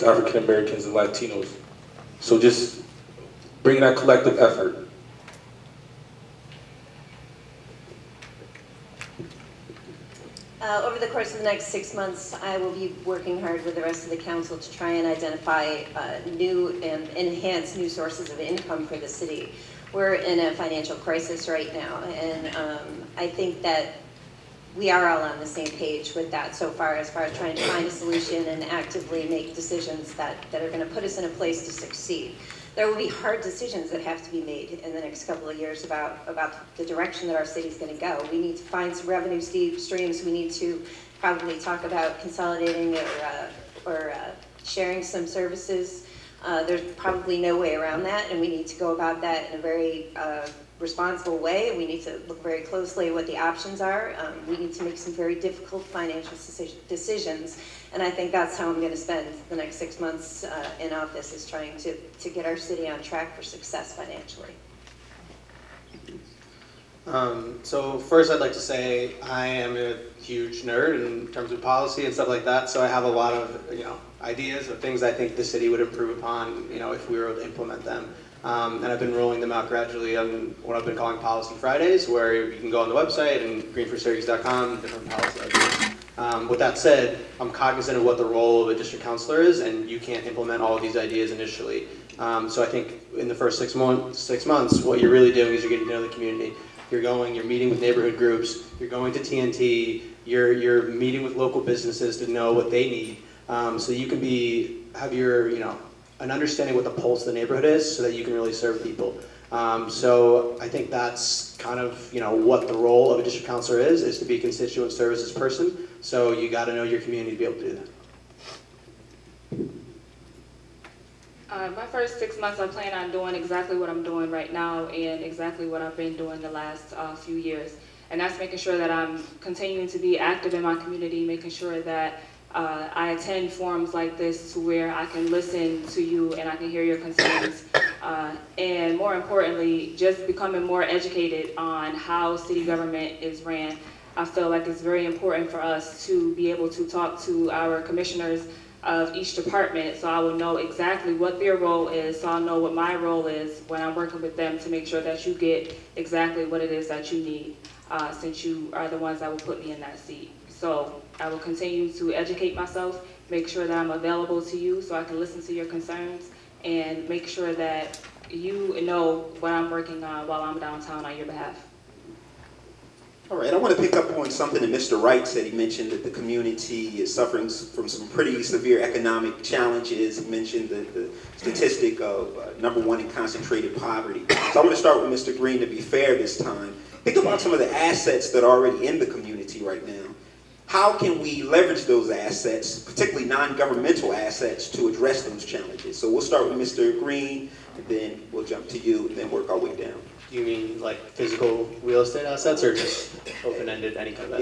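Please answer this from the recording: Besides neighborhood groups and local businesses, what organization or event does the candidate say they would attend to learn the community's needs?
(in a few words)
TNT.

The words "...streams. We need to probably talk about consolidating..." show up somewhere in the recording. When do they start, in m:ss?
0:39.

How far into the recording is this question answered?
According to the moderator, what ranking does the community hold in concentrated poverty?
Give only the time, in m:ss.
3:02.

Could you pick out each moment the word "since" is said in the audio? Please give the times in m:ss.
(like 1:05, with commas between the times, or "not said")
2:38.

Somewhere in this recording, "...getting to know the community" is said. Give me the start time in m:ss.
1:35.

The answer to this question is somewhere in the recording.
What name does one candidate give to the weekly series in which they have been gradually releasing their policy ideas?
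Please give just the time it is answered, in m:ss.
1:21.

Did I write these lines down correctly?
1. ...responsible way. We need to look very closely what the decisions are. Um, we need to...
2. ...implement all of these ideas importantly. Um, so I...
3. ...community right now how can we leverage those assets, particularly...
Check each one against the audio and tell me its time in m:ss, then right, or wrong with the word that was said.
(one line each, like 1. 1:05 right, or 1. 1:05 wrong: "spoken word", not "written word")
1. 0:50 wrong: "options", not "decisions"
2. 1:30 wrong: "initially", not "importantly"
3. 3:09 right.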